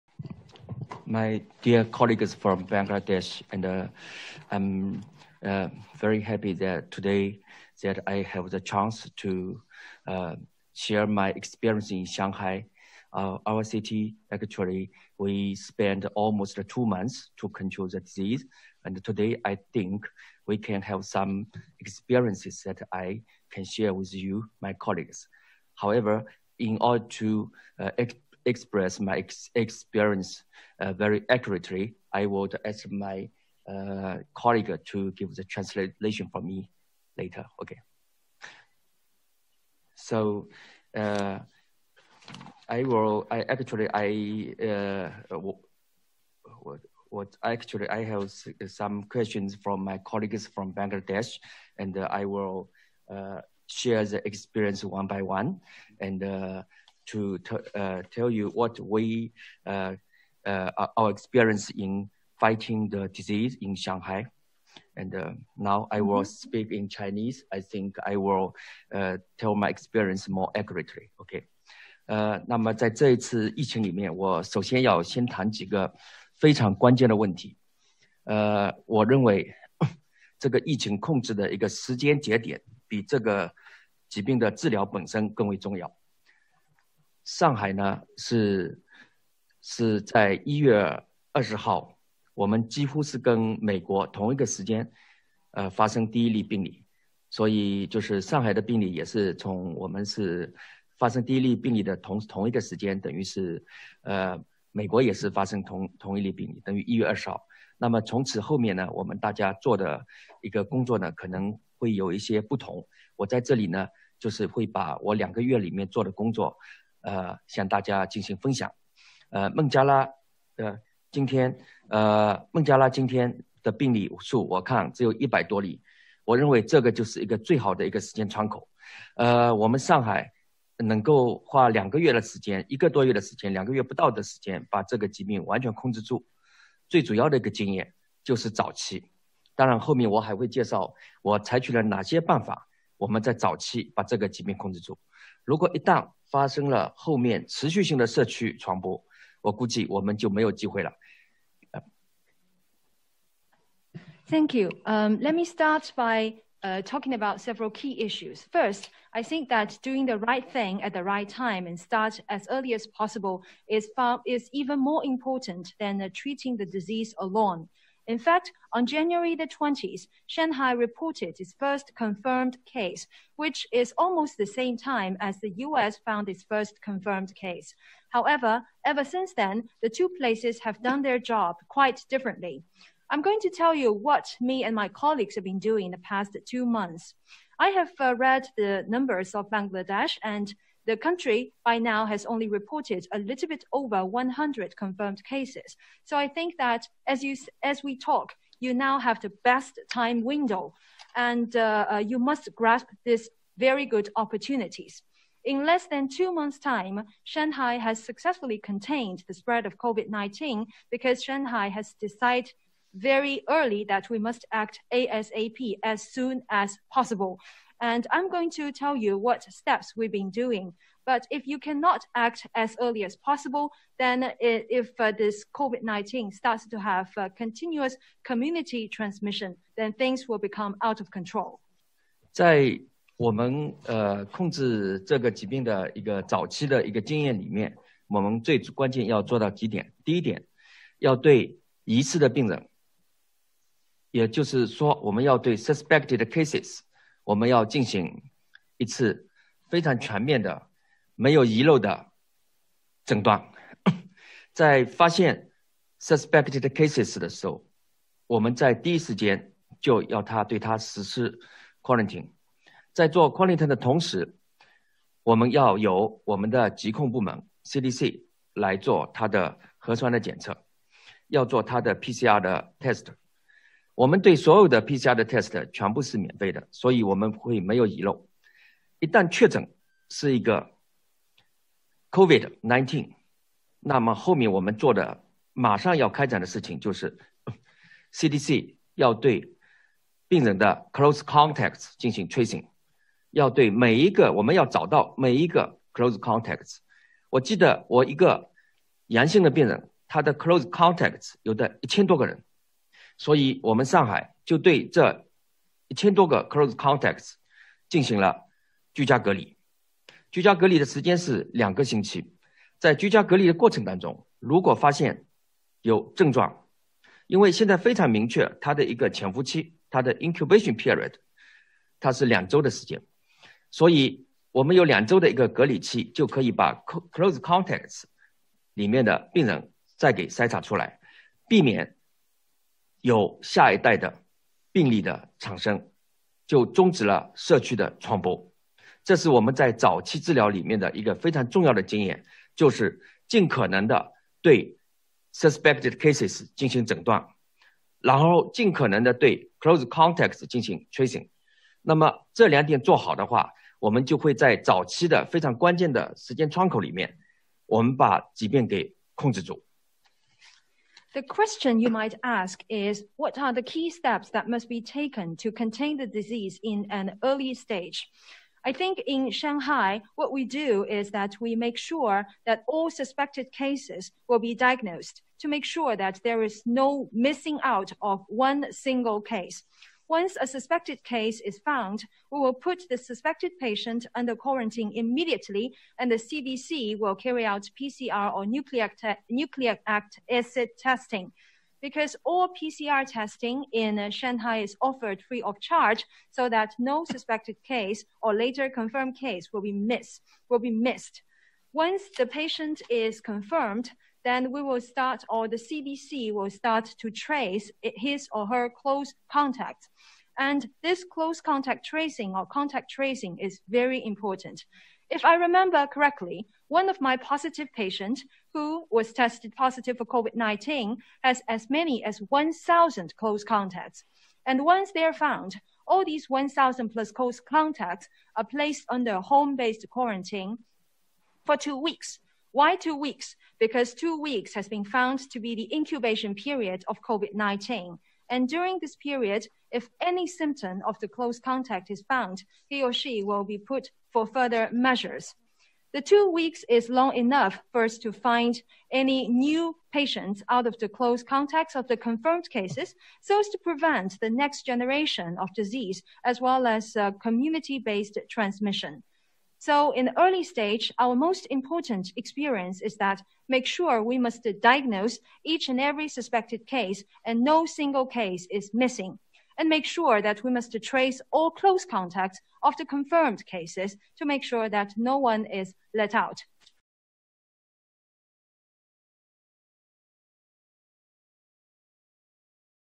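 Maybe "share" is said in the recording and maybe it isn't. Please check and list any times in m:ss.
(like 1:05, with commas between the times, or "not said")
0:10, 0:23, 0:53.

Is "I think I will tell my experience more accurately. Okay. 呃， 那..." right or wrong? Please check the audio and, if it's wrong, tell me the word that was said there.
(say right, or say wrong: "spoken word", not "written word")
right.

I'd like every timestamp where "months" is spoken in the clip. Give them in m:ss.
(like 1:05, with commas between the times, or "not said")
0:16, 3:06, 3:26.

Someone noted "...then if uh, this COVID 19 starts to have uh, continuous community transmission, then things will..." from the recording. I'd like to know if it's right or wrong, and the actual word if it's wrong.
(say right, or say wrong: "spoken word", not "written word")
right.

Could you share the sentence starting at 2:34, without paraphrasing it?
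Um, let me start by uh, talking about several key issues.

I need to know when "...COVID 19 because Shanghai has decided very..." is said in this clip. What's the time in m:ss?
3:29.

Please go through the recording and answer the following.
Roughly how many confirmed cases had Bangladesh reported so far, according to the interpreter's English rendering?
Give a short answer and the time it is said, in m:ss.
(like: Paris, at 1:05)
a little over 100, at 3:13.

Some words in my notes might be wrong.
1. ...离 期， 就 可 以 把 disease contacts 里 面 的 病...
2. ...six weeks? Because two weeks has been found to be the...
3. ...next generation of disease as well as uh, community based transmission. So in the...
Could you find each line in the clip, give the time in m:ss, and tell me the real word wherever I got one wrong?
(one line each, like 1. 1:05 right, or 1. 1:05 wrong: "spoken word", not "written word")
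1. 5:25 wrong: "close", not "disease"
2. 7:12 wrong: "two", not "six"
3. 7:34 right.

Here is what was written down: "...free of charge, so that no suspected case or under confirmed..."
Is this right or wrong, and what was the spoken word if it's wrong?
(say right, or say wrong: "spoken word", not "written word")
wrong: "later", not "under".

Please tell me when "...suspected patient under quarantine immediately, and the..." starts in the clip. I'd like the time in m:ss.
6:22.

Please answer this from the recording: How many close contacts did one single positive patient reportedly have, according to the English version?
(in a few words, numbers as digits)
1,000.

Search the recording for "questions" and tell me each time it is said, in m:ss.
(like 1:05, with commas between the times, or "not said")
0:49, 6:01.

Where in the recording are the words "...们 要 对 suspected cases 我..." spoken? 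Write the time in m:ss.
4:05.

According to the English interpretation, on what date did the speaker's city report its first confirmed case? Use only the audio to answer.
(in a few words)
January 20th.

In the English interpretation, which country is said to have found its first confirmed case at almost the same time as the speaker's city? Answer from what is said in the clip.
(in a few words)
the US.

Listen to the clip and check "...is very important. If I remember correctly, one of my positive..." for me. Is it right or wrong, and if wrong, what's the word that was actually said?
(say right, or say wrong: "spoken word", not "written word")
right.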